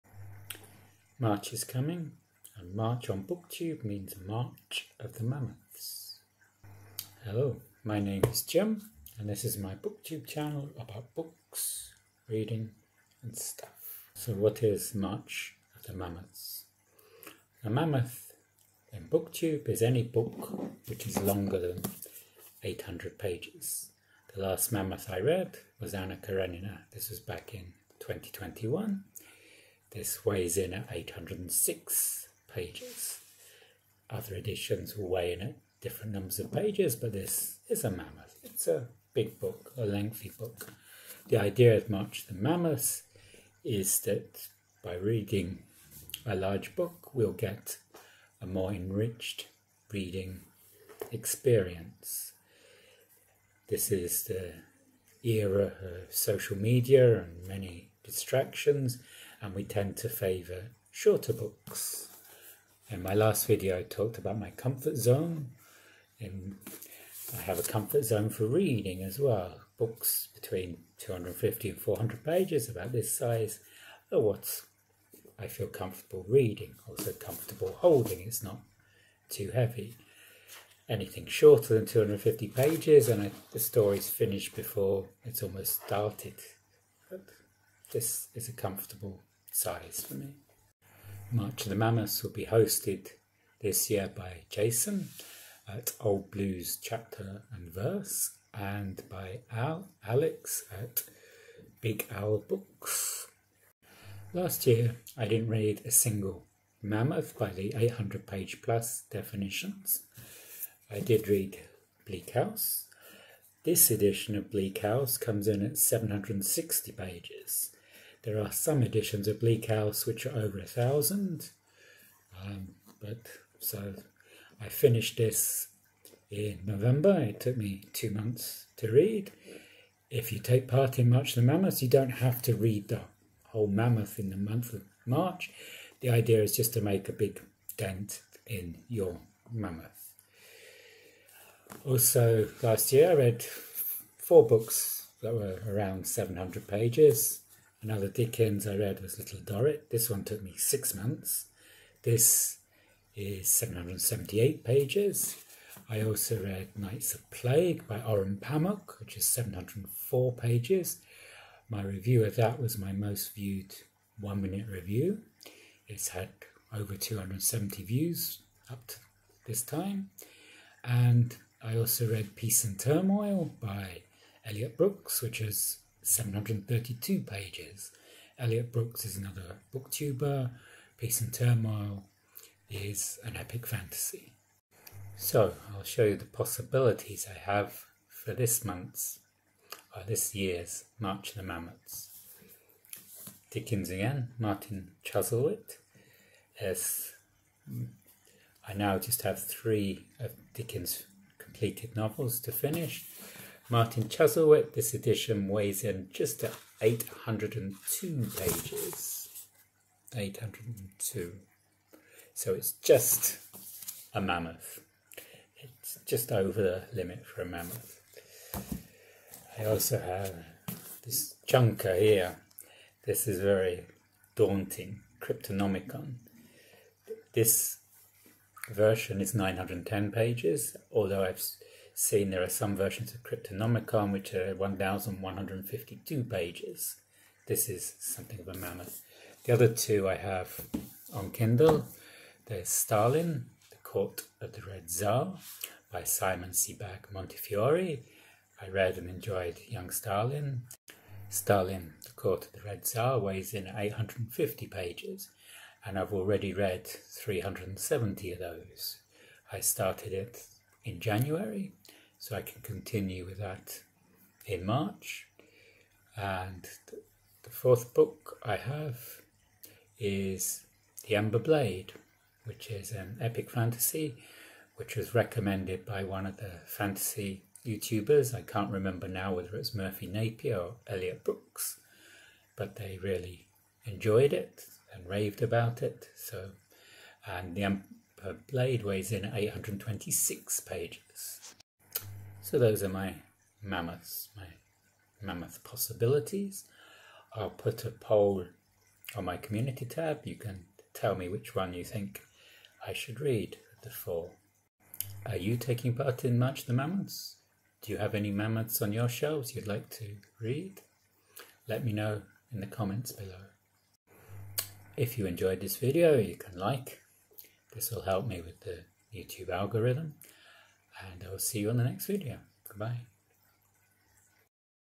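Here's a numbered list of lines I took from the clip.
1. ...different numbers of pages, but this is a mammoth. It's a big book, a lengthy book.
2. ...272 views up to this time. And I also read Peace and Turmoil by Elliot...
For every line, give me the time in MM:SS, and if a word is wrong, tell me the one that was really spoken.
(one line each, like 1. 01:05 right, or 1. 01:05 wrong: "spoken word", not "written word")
1. 00:35 right
2. 02:46 wrong: "270", not "272".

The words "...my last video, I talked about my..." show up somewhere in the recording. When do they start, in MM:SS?
01:03.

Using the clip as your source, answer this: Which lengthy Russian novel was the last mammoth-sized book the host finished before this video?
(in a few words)
Anna Karenina.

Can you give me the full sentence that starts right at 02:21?
Also, last year I read four books that were around 700 pages.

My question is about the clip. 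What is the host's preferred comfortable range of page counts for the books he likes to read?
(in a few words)
250 to 400 pages.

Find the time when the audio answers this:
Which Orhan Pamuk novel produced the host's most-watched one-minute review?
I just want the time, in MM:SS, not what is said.
02:36.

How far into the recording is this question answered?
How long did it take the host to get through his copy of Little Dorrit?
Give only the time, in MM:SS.
02:30.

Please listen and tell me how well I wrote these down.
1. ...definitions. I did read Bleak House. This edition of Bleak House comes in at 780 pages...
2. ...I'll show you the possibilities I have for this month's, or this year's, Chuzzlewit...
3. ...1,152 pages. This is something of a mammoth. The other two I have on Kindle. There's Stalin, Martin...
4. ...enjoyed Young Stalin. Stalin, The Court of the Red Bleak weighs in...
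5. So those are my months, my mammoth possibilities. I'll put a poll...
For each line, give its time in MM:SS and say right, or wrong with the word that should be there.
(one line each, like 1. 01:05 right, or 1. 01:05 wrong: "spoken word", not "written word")
1. 01:49 wrong: "760", not "780"
2. 03:05 wrong: "March", not "Chuzzlewit"
3. 03:54 wrong: "The", not "Martin"
4. 04:09 wrong: "Tsar", not "Bleak"
5. 04:52 wrong: "mammoths", not "months".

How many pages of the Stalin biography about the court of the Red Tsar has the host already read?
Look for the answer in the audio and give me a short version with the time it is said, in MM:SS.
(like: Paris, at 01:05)
370, at 04:16.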